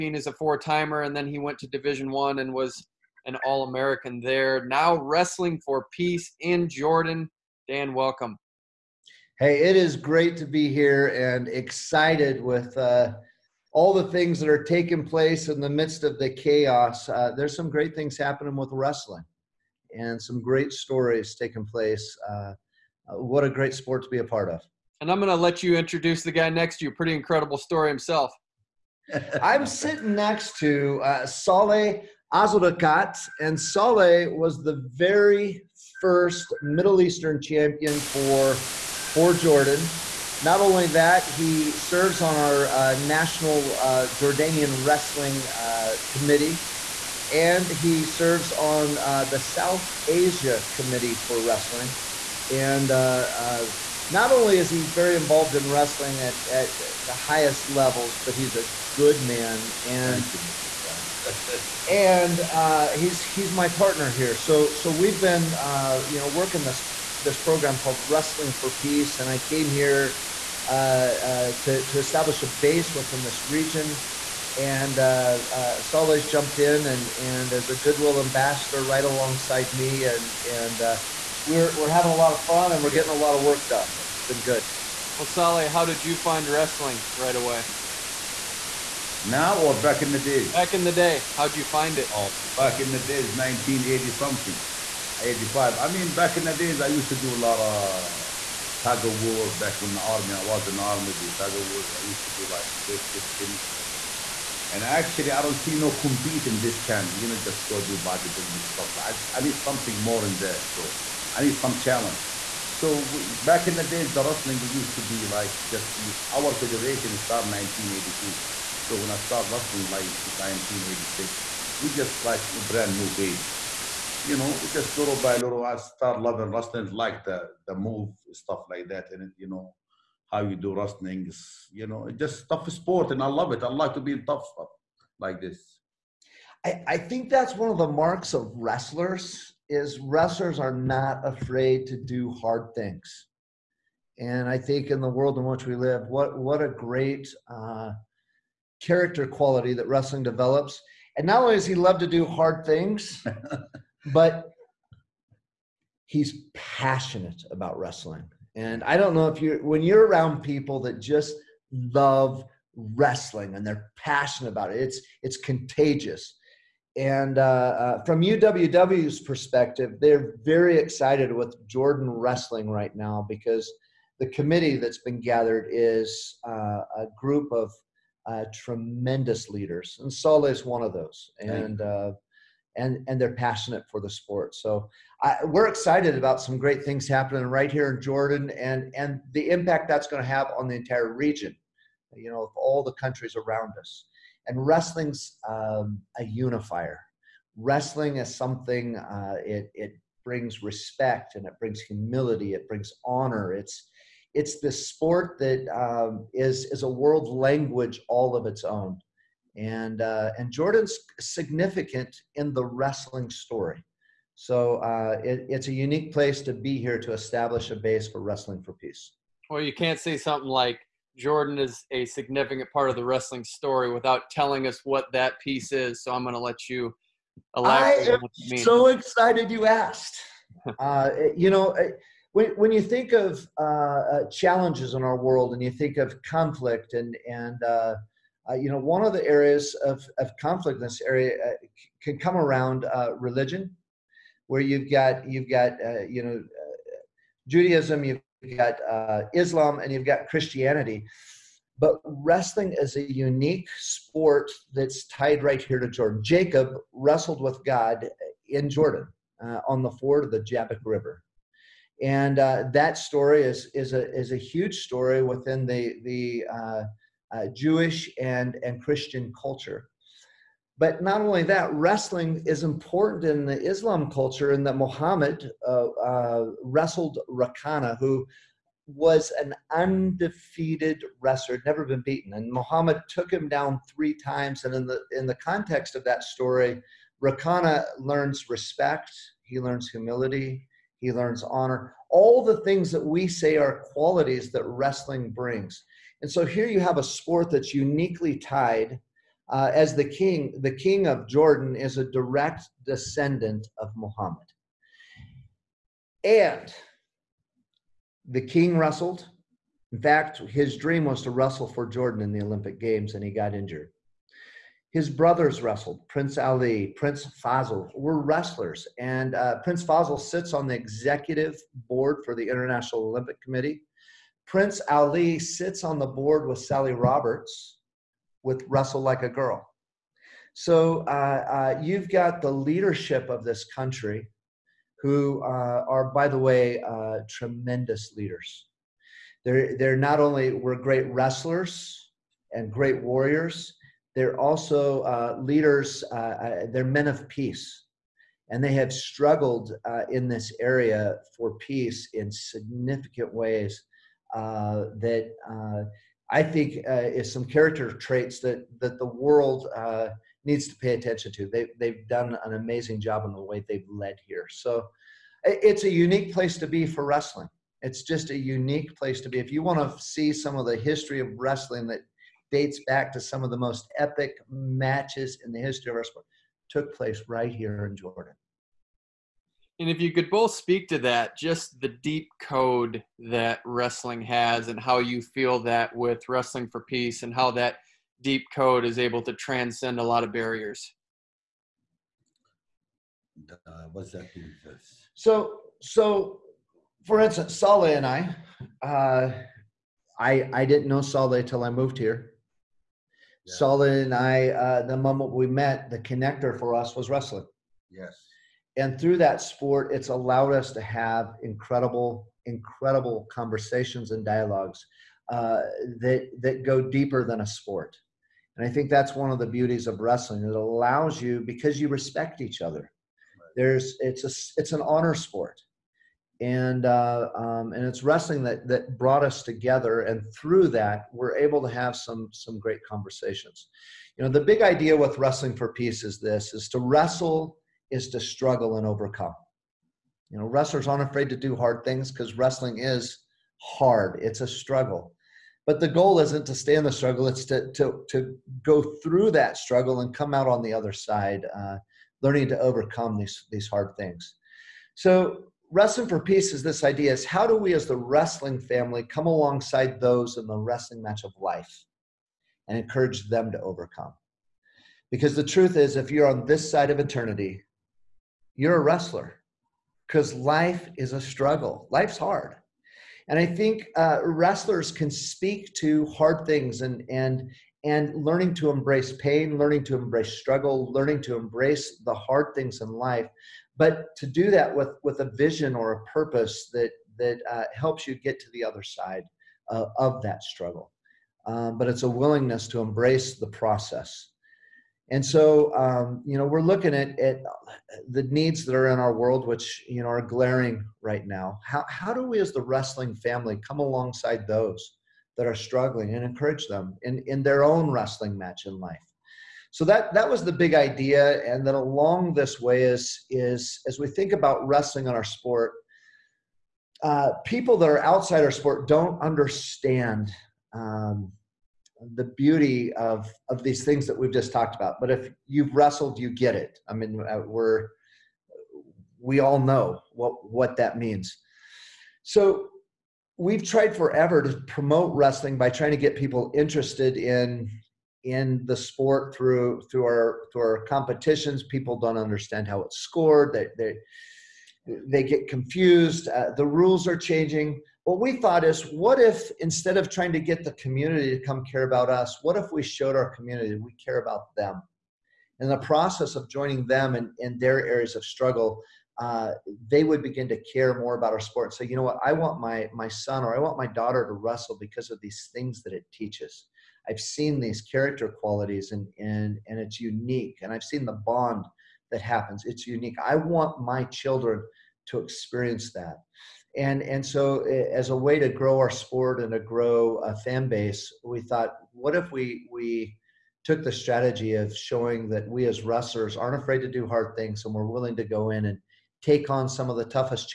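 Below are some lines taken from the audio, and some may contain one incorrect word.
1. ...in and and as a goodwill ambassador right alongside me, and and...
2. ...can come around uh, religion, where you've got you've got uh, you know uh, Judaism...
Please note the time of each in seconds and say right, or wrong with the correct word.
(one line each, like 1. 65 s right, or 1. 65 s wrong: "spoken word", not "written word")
1. 76 s right
2. 242 s right.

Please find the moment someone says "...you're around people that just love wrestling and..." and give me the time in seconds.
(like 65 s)
159 s.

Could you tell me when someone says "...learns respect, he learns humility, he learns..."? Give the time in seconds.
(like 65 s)
287 s.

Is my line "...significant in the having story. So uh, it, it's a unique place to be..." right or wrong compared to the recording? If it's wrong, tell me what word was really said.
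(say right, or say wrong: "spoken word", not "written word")
wrong: "wrestling", not "having".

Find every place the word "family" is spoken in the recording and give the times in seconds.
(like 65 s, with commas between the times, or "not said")
458 s, 503 s.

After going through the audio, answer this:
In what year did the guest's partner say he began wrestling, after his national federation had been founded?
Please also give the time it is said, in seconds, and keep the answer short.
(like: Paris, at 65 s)
1986, at 120 s.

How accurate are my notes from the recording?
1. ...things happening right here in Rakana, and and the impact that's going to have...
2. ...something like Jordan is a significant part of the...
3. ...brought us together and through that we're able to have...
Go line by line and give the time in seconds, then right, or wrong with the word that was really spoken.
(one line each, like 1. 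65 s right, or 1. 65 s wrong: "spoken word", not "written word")
1. 186 s wrong: "Jordan", not "Rakana"
2. 220 s right
3. 428 s right.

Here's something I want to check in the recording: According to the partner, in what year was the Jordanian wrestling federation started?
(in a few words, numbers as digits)
1982.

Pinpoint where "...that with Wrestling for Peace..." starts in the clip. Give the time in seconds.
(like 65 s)
385 s.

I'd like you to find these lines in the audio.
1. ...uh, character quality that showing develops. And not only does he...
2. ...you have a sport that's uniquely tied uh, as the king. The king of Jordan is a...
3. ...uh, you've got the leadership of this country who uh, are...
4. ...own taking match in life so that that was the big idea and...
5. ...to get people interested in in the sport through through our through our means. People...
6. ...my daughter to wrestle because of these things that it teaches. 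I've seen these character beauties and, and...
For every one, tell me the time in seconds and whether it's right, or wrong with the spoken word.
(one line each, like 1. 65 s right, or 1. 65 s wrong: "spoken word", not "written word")
1. 147 s wrong: "wrestling", not "showing"
2. 296 s right
3. 331 s right
4. 507 s wrong: "wrestling", not "taking"
5. 535 s wrong: "competitions", not "means"
6. 563 s wrong: "qualities", not "beauties".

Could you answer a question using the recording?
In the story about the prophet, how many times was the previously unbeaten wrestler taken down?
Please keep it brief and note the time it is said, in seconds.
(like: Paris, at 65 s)
3, at 283 s.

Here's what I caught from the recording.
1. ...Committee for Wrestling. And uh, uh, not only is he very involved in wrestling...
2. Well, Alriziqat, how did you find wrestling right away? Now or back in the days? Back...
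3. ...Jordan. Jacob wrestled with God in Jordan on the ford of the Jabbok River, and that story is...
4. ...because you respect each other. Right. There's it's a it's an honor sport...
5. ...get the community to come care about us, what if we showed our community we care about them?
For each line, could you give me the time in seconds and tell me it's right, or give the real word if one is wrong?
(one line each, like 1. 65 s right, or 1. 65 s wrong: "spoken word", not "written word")
1. 50 s right
2. 85 s wrong: "Saleh", not "Alriziqat"
3. 255 s right
4. 421 s right
5. 550 s right.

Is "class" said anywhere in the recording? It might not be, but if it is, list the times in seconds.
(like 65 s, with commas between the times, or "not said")
not said.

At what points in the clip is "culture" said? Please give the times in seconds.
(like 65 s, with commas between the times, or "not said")
269 s, 274 s.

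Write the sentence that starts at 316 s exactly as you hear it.
Prince Ali, Prince Feisal were wrestlers.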